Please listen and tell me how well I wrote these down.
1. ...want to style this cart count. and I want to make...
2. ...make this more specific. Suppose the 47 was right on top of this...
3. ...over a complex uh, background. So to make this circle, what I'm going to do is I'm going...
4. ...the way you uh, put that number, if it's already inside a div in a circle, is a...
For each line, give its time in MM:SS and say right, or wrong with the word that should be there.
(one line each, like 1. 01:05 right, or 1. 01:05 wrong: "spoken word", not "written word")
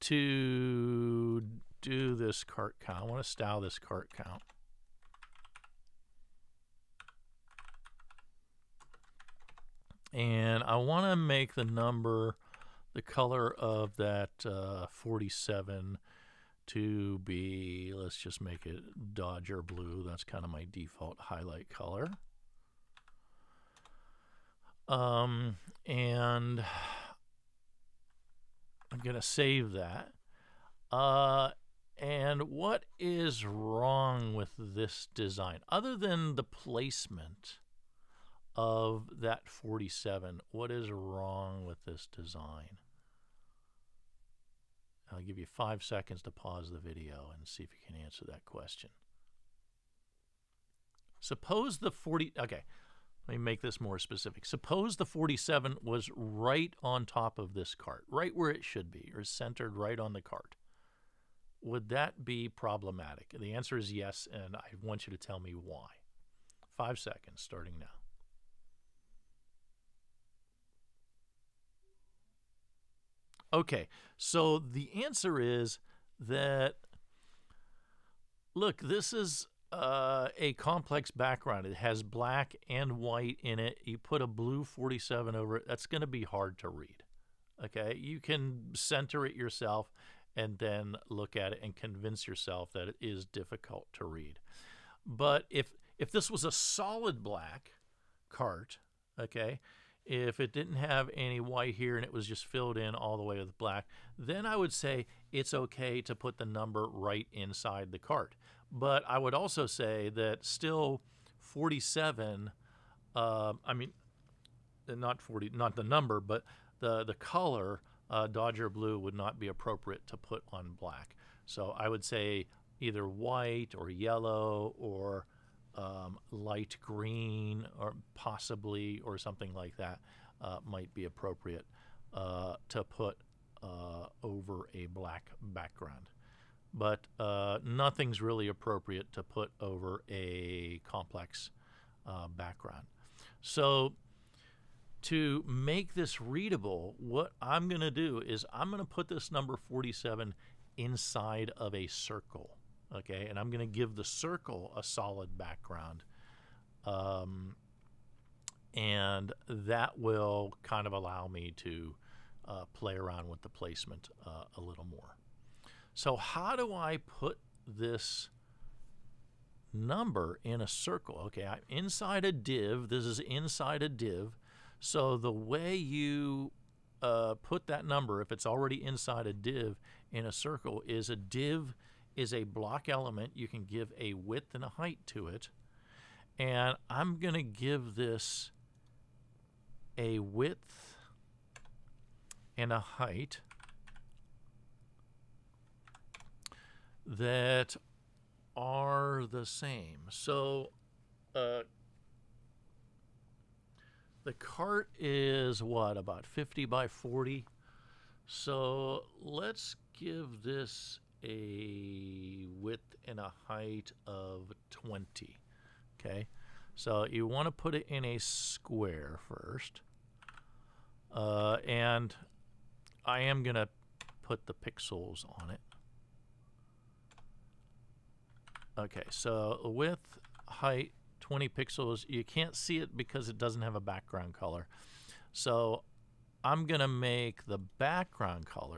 1. 00:03 right
2. 00:53 right
3. 02:19 wrong: "readable", not "circle"
4. 02:55 right.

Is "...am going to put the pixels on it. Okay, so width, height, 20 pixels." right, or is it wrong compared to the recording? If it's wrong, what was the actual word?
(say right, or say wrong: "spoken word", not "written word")
right.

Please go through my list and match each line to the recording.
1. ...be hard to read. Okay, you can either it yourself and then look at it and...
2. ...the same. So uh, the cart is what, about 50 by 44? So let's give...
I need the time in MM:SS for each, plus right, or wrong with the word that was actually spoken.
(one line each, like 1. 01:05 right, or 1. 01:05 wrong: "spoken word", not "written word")
1. 01:26 wrong: "center", not "either"
2. 03:19 wrong: "40", not "44".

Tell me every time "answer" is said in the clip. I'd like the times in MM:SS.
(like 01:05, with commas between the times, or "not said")
00:48, 01:03, 01:15.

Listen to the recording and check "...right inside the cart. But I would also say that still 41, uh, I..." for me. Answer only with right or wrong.
wrong.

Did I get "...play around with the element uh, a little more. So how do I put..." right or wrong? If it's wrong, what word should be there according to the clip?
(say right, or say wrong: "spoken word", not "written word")
wrong: "placement", not "element".